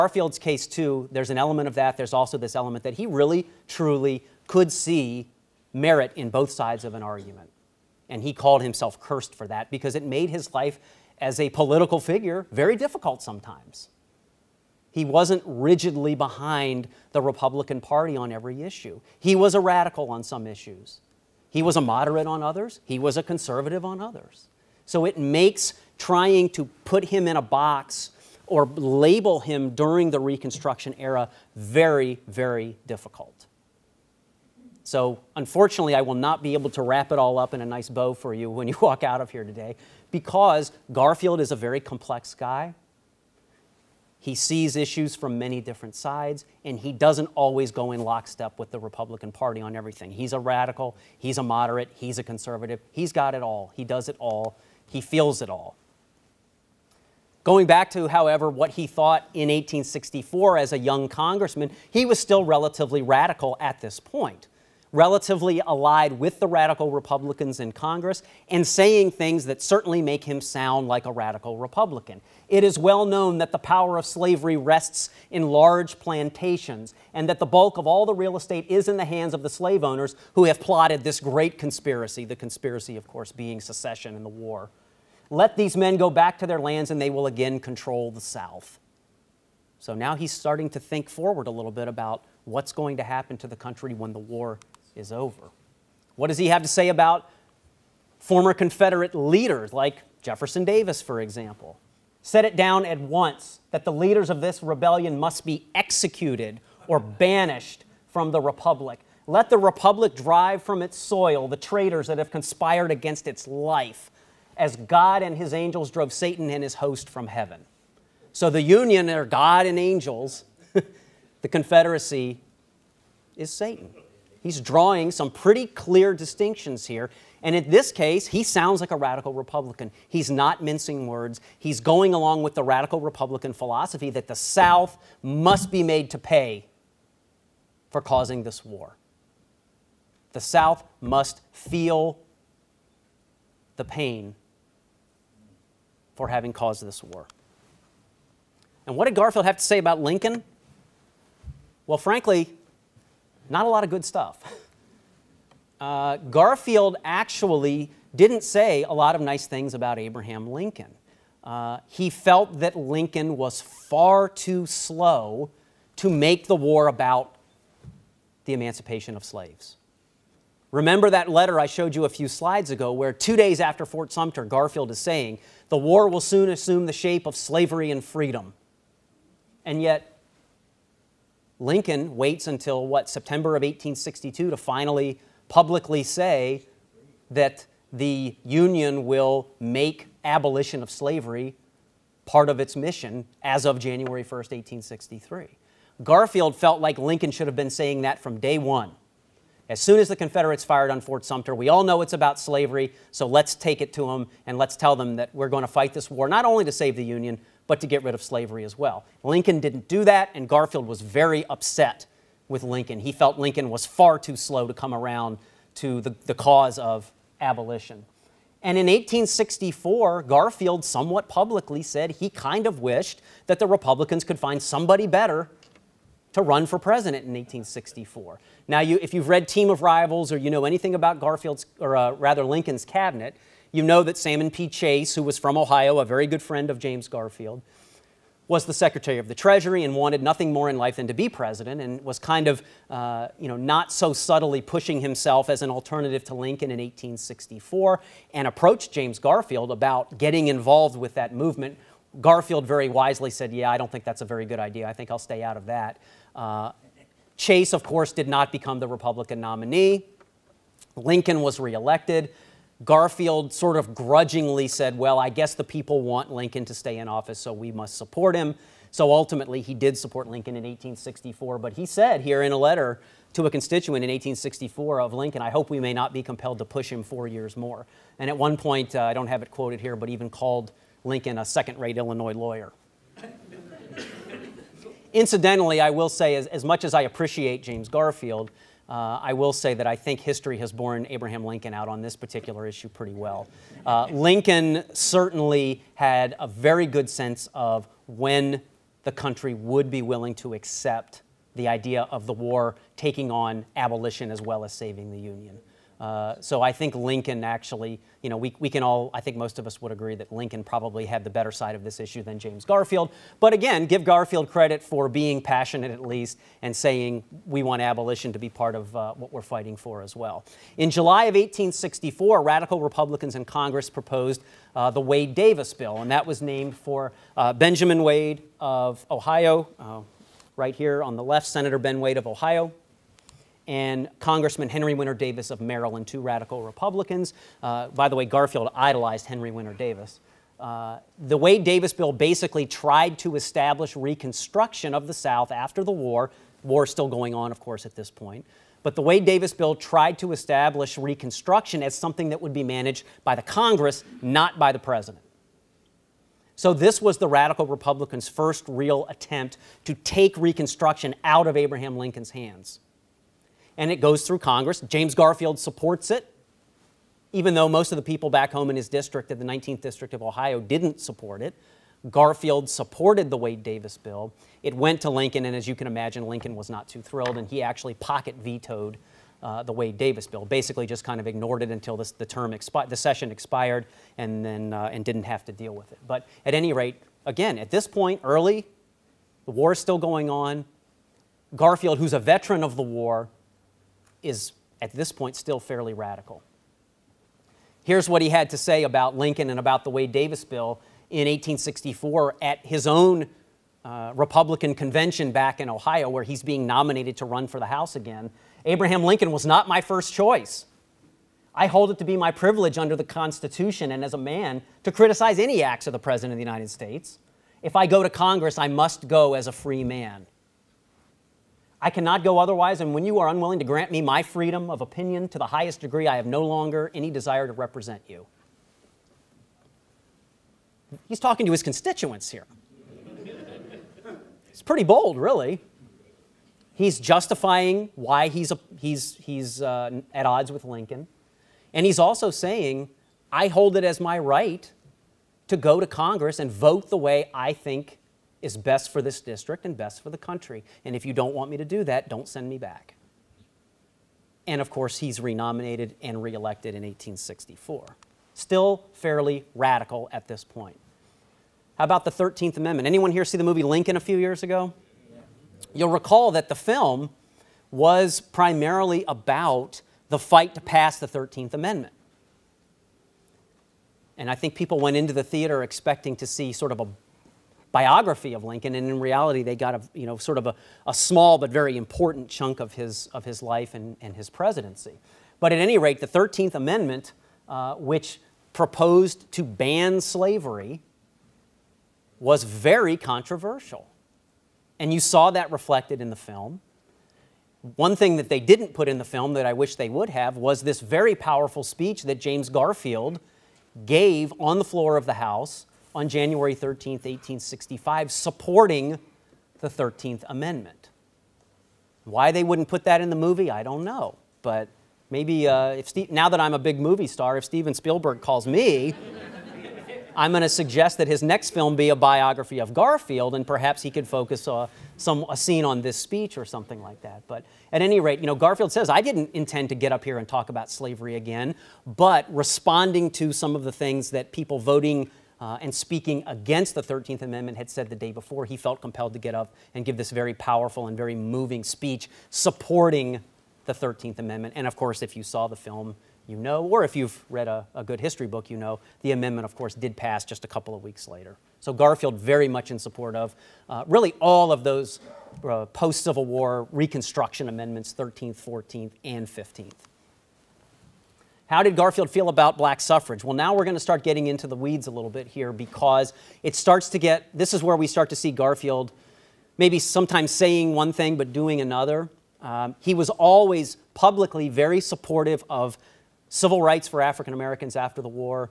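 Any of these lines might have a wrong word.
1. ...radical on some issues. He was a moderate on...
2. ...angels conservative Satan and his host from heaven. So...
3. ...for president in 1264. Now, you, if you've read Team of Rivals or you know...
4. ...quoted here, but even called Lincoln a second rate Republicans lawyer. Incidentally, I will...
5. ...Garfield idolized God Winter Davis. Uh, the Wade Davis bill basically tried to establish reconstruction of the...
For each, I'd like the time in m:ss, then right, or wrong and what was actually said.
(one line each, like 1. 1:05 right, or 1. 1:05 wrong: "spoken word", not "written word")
1. 0:19 right
2. 1:55 wrong: "drove", not "conservative"
3. 3:46 wrong: "1864", not "1264"
4. 4:39 wrong: "Illinois", not "Republicans"
5. 5:38 wrong: "Henry", not "God".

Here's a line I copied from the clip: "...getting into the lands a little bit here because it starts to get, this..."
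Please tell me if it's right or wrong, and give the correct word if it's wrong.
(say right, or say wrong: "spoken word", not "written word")
wrong: "weeds", not "lands".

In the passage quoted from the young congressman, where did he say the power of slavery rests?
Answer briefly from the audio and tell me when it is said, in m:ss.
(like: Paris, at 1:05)
Large plantations, at 1:15.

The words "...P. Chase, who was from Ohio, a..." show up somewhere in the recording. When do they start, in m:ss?
3:54.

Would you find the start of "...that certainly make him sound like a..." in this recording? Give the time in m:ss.
1:09.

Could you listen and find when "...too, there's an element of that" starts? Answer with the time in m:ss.
0:00.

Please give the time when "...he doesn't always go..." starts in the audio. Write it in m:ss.
0:46.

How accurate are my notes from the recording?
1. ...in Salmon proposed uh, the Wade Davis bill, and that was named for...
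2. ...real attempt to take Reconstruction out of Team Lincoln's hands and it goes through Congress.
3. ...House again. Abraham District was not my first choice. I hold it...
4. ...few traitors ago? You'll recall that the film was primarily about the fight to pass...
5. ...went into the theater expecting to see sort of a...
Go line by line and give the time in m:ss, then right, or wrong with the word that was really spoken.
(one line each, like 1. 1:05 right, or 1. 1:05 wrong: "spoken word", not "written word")
1. 5:23 wrong: "Congress", not "Salmon"
2. 5:58 wrong: "Abraham", not "Team"
3. 6:47 wrong: "Lincoln", not "District"
4. 7:43 wrong: "years", not "traitors"
5. 7:54 right.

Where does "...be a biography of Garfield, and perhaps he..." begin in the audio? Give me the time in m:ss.
8:41.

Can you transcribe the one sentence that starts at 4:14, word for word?
I think I'll stay out of that.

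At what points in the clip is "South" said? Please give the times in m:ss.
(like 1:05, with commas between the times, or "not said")
1:28, 2:14, 2:20, 5:45.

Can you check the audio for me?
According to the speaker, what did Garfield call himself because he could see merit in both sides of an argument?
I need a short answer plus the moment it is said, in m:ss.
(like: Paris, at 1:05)
Cursed, at 0:08.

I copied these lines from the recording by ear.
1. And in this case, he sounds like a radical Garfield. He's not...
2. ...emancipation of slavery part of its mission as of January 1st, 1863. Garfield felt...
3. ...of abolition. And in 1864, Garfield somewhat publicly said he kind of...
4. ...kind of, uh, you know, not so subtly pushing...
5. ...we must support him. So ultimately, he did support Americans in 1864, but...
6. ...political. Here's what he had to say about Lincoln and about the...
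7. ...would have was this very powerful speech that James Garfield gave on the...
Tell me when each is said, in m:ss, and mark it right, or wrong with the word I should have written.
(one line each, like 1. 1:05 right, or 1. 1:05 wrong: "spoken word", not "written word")
1. 2:07 wrong: "Republican", not "Garfield"
2. 3:10 wrong: "abolition", not "emancipation"
3. 3:36 right
4. 4:02 right
5. 4:27 wrong: "Lincoln", not "Americans"
6. 6:35 wrong: "radical", not "political"
7. 8:19 right.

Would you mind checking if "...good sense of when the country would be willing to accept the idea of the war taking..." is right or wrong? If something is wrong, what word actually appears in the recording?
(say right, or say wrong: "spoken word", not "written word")
right.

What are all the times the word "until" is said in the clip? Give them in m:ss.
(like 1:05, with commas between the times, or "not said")
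3:02, 6:21.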